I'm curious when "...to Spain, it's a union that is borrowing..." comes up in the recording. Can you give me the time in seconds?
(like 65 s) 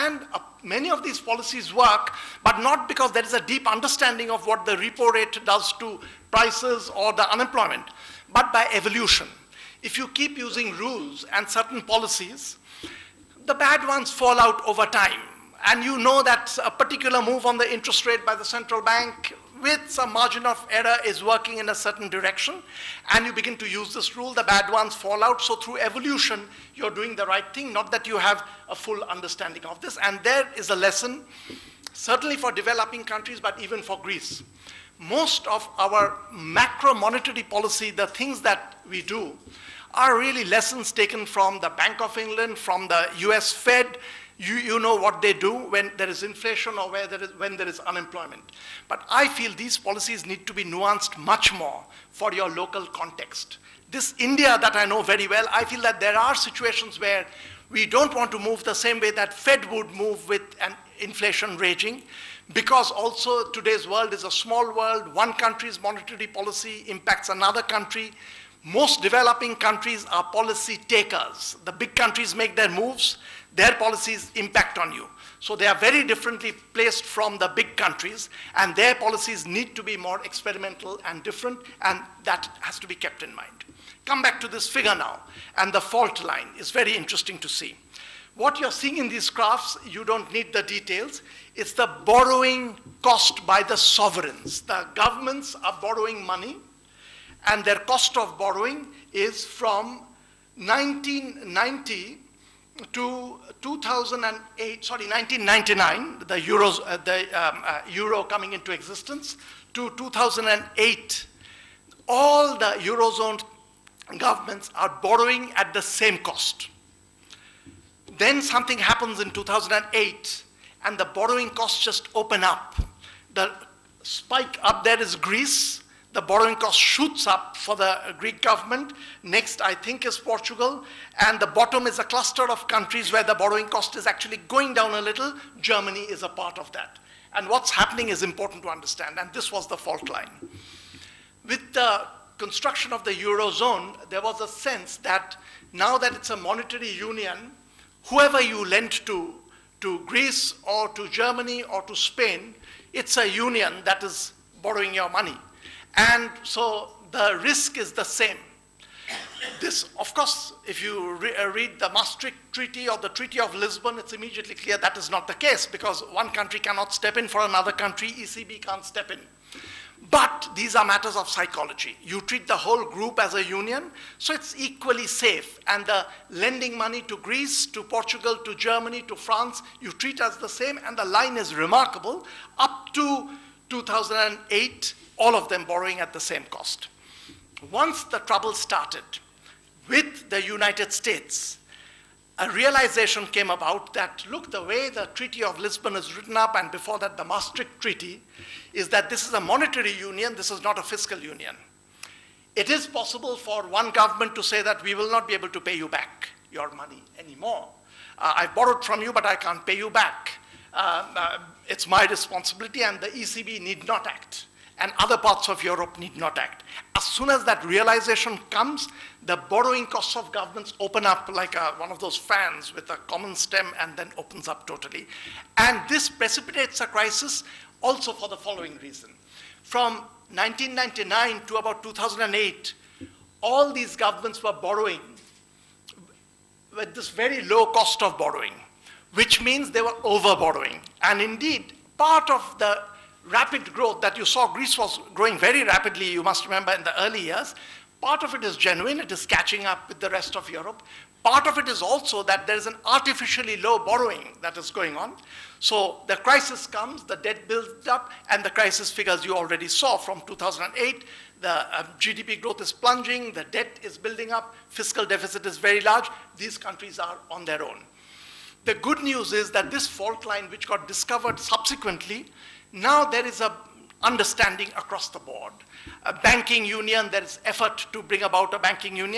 151 s.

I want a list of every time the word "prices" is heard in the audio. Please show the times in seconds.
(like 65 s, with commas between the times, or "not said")
6 s.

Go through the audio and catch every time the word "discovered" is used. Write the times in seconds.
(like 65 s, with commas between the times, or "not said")
270 s.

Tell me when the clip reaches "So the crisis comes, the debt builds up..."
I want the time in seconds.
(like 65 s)
255 s.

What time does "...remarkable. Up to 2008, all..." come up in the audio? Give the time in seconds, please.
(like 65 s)
181 s.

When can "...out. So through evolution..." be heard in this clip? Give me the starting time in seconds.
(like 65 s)
25 s.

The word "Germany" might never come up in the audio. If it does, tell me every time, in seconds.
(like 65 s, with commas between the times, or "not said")
135 s, 151 s, 178 s.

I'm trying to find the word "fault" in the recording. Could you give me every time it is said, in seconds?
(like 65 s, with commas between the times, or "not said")
85 s, 139 s, 269 s.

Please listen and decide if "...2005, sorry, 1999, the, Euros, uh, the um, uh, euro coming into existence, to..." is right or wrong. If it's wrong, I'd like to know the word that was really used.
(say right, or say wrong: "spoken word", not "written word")
wrong: "2008", not "2005".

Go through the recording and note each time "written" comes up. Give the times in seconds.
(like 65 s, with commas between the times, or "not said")
196 s.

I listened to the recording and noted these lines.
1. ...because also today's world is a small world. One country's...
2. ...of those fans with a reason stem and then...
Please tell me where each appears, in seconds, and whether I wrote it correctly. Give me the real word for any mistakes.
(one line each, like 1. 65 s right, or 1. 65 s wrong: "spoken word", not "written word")
1. 62 s right
2. 221 s wrong: "common", not "reason".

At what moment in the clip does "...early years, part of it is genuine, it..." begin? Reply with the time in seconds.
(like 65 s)
247 s.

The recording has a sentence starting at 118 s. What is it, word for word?
Then something happens in 2008, and the borrowing costs just open up.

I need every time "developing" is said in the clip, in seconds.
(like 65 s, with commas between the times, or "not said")
32 s, 69 s.